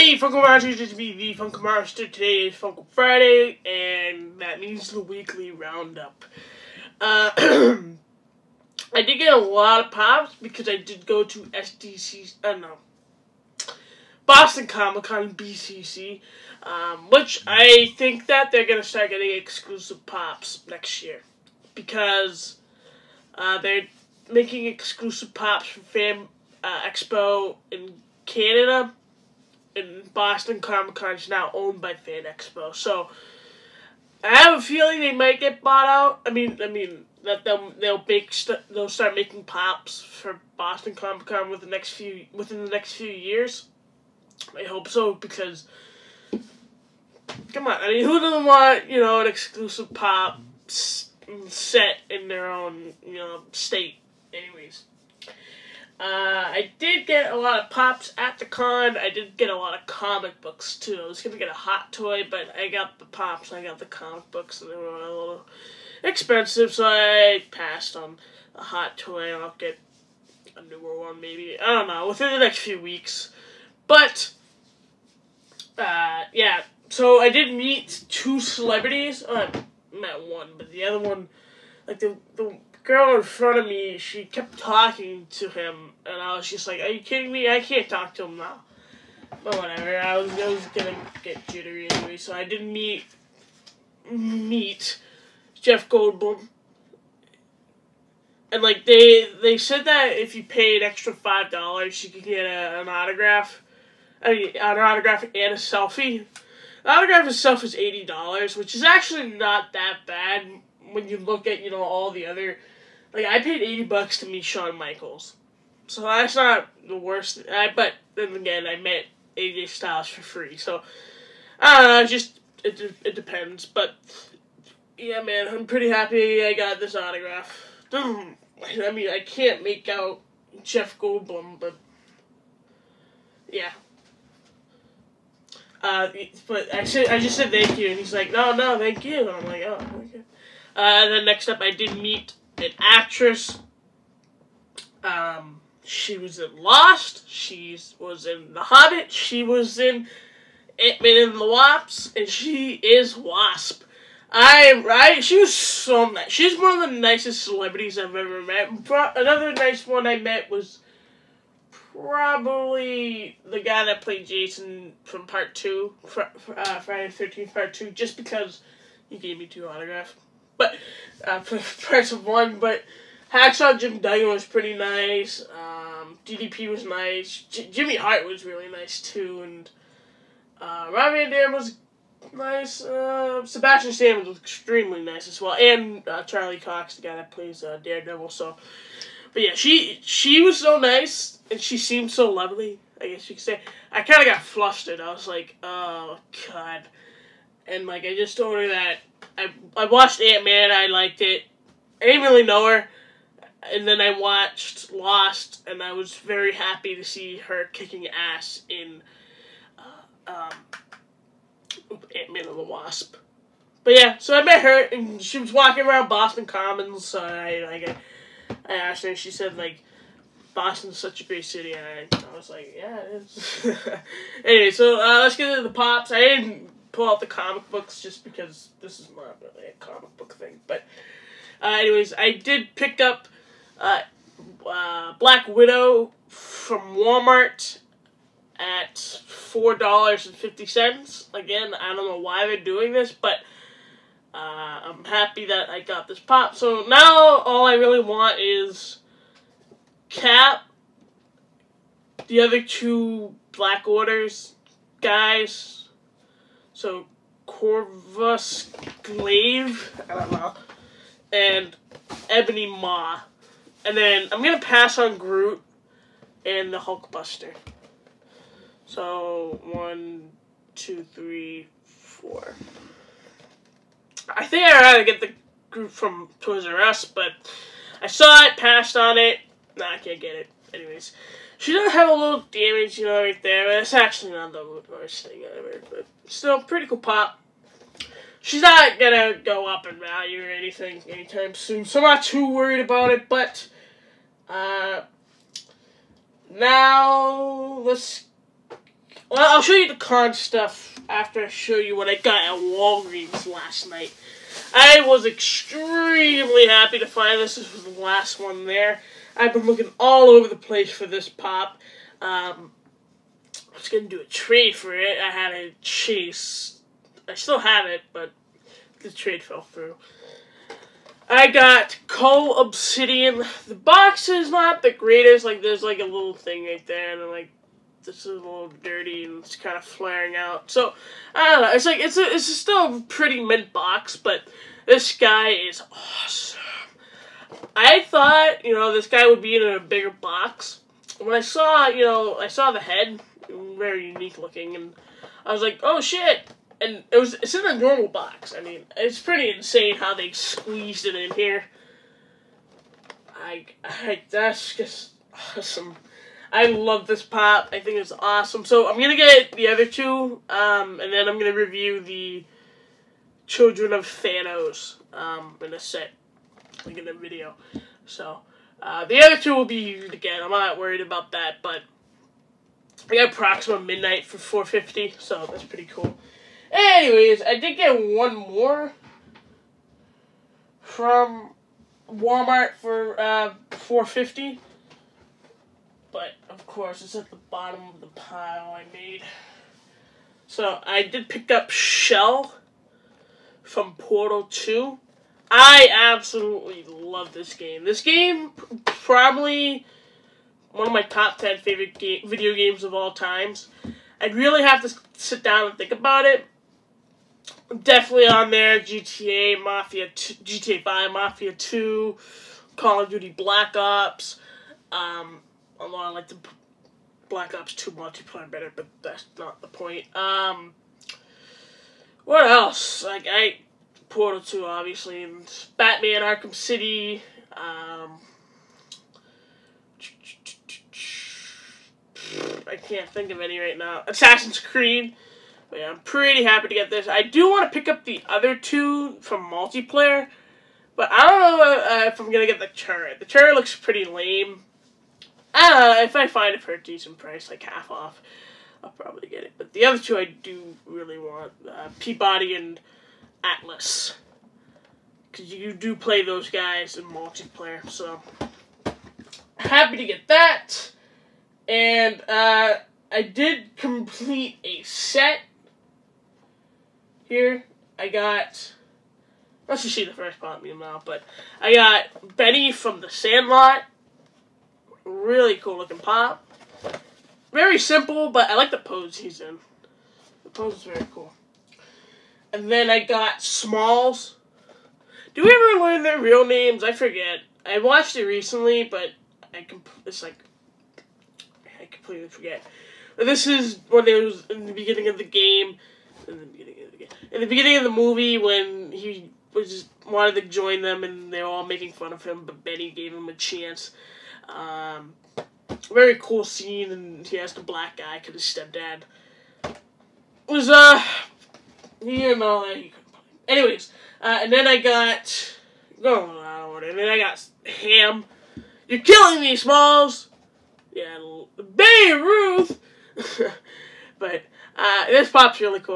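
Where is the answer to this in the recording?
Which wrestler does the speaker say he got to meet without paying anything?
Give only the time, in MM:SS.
01:59.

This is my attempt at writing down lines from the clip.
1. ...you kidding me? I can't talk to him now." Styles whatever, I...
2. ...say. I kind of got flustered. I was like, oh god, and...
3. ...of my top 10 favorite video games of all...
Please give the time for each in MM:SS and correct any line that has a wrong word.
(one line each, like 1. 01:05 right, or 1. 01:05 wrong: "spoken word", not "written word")
1. 01:26 wrong: "But", not "Styles"
2. 03:13 right
3. 06:40 right.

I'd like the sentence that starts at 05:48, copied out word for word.
I mean, it's pretty insane how they squeezed it in here.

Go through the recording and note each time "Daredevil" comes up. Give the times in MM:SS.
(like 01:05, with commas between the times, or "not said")
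03:07.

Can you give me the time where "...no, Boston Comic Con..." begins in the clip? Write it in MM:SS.
00:12.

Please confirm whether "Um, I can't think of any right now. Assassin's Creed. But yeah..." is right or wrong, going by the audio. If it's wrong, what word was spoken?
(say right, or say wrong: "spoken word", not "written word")
right.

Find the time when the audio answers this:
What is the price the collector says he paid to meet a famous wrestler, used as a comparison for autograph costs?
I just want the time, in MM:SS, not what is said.
01:53.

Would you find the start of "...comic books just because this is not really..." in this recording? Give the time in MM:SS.
03:47.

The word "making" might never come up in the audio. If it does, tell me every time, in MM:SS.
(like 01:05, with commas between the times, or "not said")
00:24, 00:39, 08:21.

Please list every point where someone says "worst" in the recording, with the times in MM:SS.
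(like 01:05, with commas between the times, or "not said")
01:56, 04:44.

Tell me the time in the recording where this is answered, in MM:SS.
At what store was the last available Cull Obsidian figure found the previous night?
05:02.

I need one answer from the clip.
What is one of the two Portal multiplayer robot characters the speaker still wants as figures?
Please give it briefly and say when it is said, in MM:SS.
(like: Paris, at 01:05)
P-Body, at 07:31.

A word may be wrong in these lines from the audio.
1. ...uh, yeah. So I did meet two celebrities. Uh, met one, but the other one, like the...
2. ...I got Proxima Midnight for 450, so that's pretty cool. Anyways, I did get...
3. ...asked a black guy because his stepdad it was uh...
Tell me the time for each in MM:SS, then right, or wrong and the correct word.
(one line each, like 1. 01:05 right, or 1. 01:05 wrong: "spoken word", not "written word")
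1. 01:15 right
2. 06:13 right
3. 08:27 right.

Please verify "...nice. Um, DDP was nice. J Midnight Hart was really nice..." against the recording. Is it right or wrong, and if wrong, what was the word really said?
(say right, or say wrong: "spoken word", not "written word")
wrong: "Jimmy", not "Midnight".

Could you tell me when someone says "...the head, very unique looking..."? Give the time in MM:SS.
05:42.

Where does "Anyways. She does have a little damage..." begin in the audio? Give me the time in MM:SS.
04:40.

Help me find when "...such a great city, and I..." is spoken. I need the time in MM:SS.
03:40.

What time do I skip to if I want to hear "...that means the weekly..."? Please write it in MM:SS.
00:04.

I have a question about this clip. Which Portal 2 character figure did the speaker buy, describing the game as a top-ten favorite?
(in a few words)
Chell.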